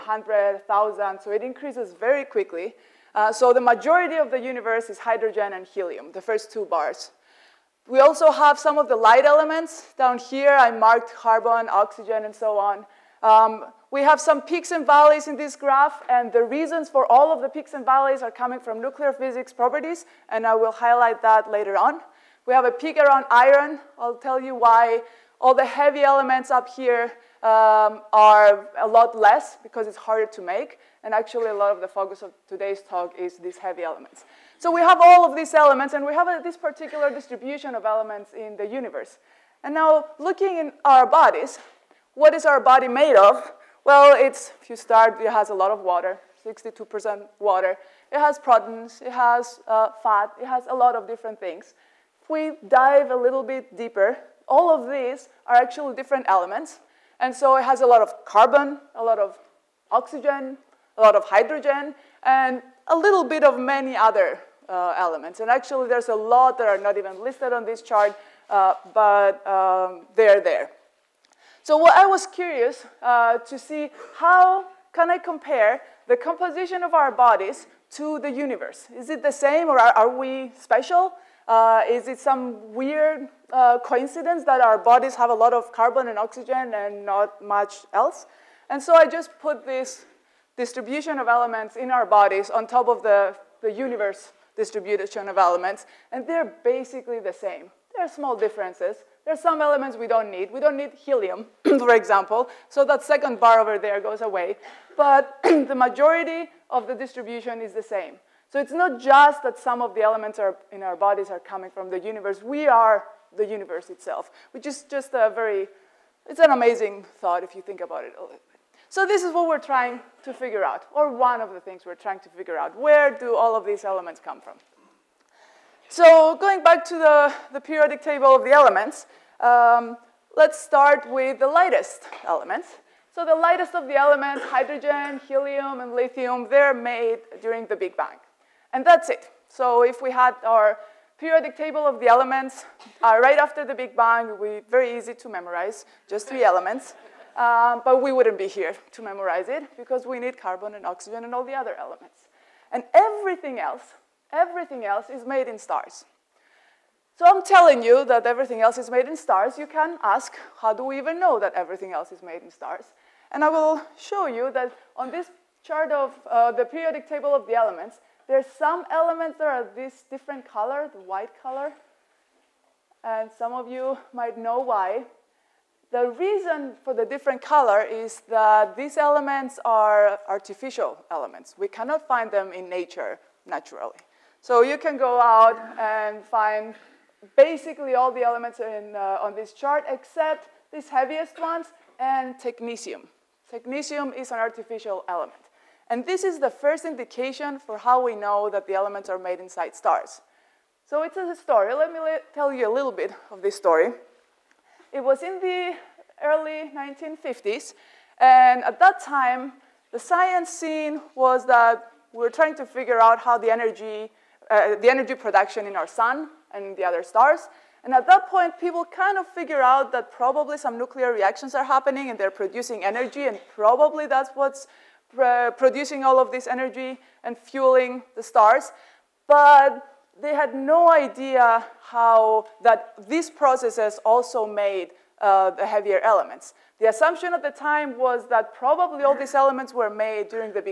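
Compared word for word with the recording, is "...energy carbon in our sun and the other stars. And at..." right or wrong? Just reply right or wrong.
wrong.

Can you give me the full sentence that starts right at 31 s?
And actually, a lot of the focus of today's talk is these heavy elements.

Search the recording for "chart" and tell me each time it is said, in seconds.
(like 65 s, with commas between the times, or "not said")
67 s, 165 s, 189 s.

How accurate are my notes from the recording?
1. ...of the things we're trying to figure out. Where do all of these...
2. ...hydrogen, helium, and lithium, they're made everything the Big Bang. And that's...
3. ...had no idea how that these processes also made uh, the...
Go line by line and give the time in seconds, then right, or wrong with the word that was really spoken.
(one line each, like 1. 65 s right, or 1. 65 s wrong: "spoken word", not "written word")
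1. 121 s right
2. 134 s wrong: "during", not "everything"
3. 230 s right.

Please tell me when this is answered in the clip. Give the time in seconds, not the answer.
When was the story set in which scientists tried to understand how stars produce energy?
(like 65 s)
206 s.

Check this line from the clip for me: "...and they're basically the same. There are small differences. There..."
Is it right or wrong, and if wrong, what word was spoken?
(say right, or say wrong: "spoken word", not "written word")
right.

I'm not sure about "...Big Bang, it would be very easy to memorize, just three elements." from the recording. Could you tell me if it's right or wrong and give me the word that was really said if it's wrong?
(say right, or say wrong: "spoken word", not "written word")
right.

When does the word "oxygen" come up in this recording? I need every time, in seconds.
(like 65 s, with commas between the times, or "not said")
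11 s, 59 s, 86 s, 150 s.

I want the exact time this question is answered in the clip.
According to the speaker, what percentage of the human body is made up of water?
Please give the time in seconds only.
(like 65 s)
46 s.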